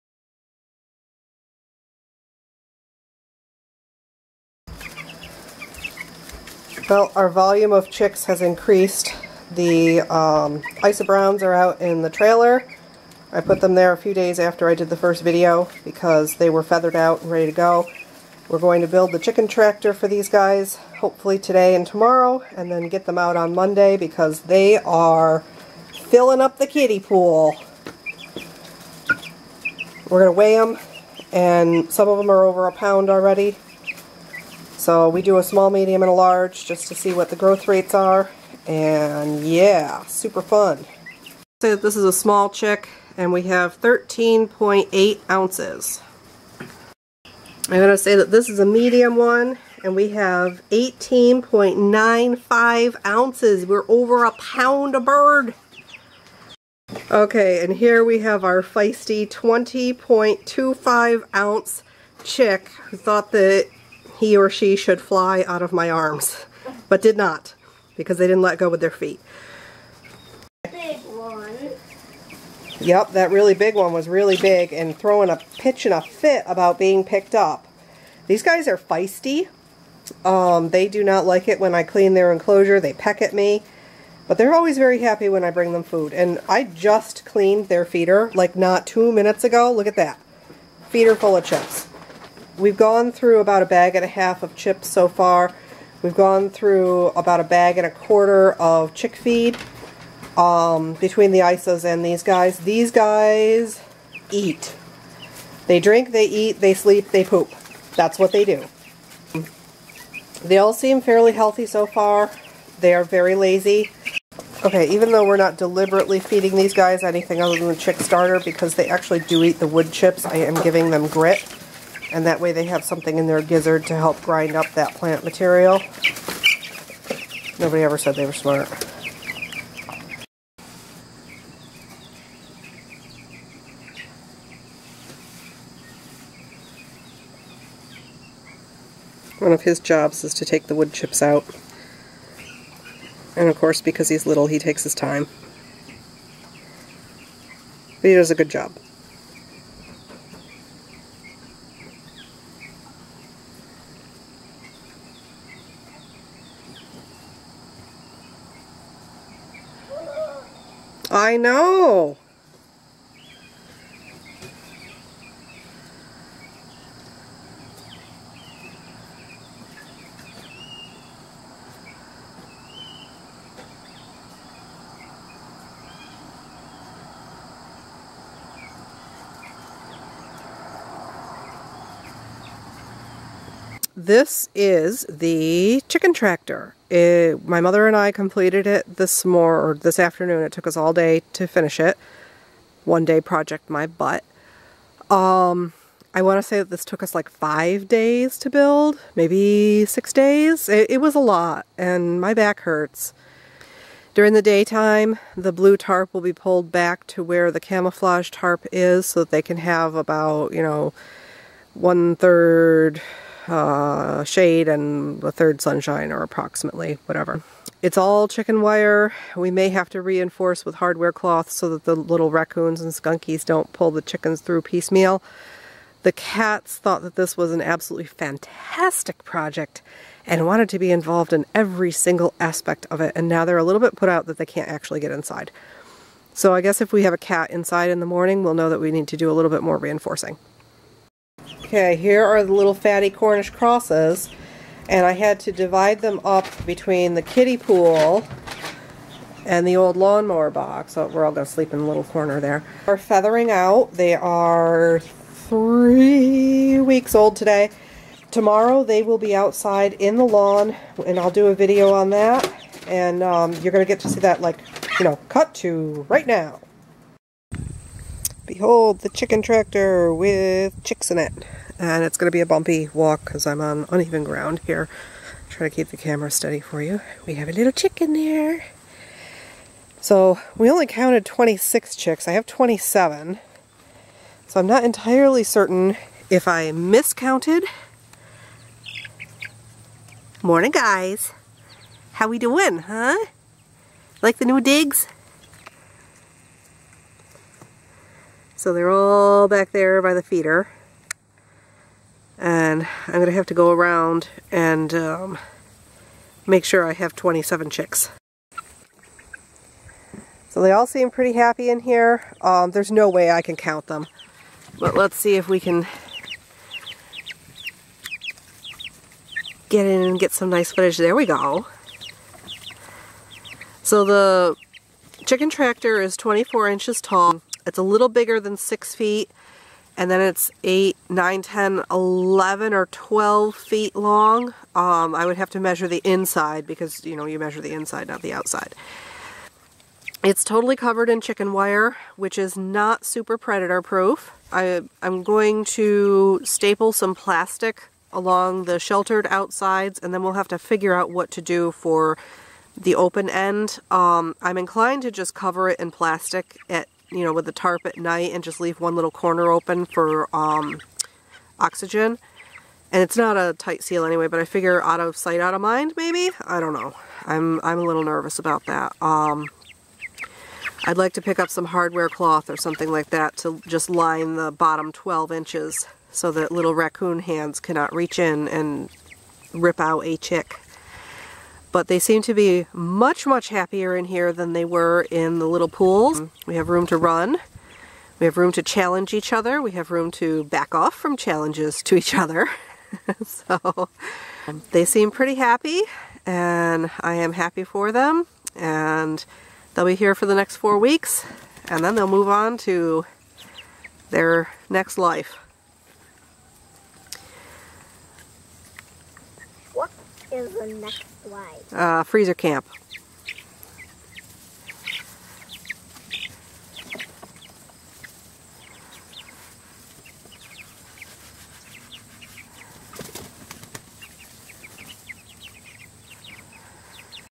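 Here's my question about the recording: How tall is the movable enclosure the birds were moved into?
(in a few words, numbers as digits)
24 inches.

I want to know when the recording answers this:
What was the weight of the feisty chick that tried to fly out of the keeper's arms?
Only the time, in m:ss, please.
0:59.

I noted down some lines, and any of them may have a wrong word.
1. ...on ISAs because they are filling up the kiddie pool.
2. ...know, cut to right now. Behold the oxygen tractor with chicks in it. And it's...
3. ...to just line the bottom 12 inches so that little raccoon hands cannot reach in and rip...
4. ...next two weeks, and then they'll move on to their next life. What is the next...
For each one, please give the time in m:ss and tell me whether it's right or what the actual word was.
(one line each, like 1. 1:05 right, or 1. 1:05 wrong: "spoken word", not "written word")
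1. 0:23 wrong: "Monday", not "ISAs"
2. 4:25 wrong: "chicken", not "oxygen"
3. 6:13 right
4. 6:40 wrong: "four", not "two".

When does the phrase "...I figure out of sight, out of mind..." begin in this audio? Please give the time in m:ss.
6:04.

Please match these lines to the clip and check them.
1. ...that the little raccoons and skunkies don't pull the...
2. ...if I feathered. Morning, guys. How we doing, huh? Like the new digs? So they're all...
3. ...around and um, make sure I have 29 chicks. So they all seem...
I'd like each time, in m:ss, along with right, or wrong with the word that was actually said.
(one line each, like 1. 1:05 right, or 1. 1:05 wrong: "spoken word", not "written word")
1. 3:41 right
2. 4:46 wrong: "miscounted", not "feathered"
3. 5:03 wrong: "27", not "29".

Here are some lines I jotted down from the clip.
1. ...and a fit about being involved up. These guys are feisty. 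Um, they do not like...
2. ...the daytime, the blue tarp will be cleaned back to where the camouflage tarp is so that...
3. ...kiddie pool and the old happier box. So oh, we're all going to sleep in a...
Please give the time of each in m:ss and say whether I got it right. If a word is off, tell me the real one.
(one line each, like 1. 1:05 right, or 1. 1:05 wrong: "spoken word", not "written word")
1. 1:15 wrong: "picked", not "involved"
2. 3:24 wrong: "pulled", not "cleaned"
3. 4:07 wrong: "lawnmower", not "happier".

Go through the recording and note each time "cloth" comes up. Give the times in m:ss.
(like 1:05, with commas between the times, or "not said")
3:41, 6:12.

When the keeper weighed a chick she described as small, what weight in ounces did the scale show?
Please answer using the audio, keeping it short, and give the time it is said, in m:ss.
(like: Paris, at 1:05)
13.8 ounces, at 0:43.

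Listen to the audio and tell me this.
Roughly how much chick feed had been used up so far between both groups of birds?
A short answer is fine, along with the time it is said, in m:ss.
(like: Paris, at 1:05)
a bag and a quarter, at 1:37.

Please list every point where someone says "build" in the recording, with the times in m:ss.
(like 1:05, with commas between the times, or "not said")
0:18, 3:18.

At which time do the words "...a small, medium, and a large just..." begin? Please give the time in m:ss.
0:35.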